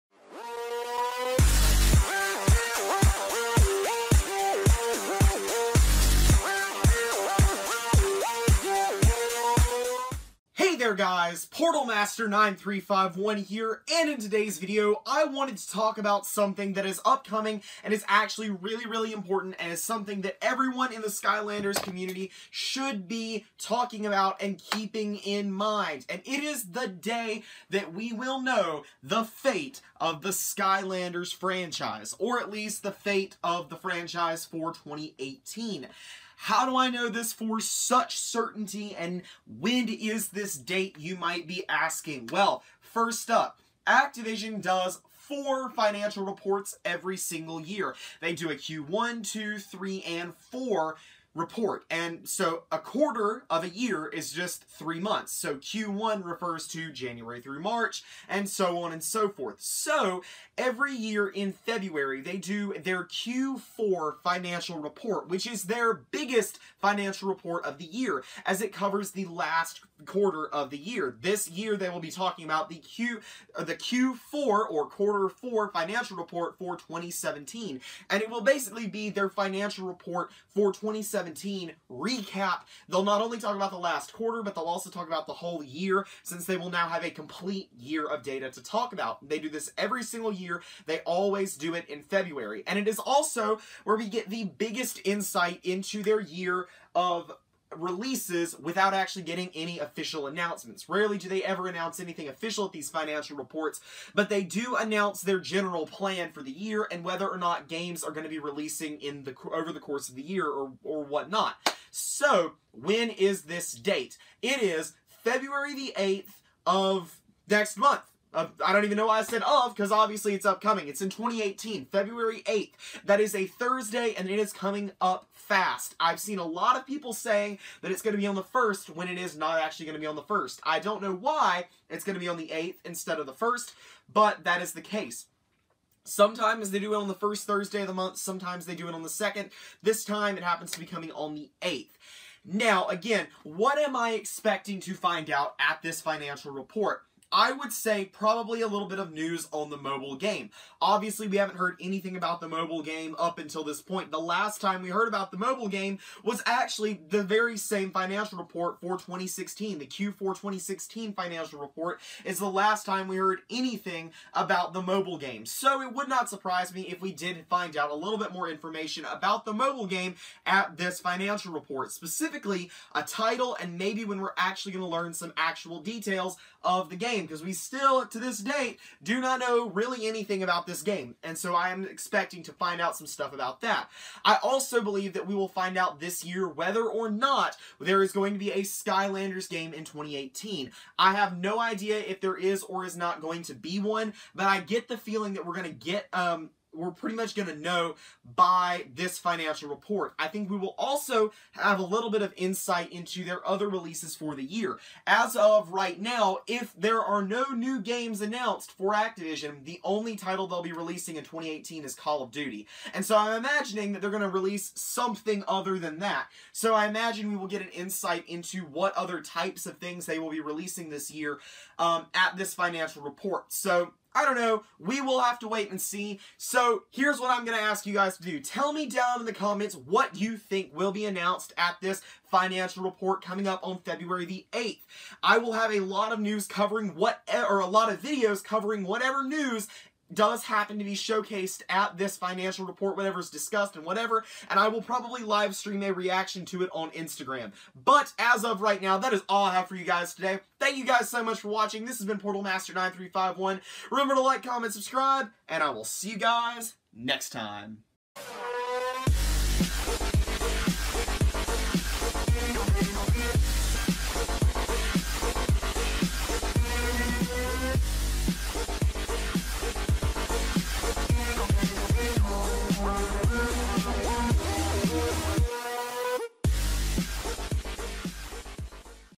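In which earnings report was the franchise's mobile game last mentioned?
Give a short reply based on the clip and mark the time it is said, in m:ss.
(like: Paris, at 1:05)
Q4 2016, at 2:39.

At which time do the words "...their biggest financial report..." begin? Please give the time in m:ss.
1:05.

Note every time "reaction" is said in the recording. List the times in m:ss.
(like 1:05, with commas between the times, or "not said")
4:05.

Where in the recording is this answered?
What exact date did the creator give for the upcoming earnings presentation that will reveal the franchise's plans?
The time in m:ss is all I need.
2:01.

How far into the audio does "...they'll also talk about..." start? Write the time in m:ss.
1:24.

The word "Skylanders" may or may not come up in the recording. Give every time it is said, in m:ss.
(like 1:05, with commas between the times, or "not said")
0:21, 0:30, 3:08.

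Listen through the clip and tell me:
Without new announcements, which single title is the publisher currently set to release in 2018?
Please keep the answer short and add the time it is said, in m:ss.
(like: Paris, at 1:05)
Call of Duty, at 3:31.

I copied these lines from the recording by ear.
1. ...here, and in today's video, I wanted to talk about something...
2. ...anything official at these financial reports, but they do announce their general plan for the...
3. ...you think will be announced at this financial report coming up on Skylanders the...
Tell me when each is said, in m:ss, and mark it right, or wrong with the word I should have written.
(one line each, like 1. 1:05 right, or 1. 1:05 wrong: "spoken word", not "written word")
1. 0:13 right
2. 1:41 right
3. 3:50 wrong: "February", not "Skylanders".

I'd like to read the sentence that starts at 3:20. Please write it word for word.
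I think we will also have a little bit of insight into their other releases for the year.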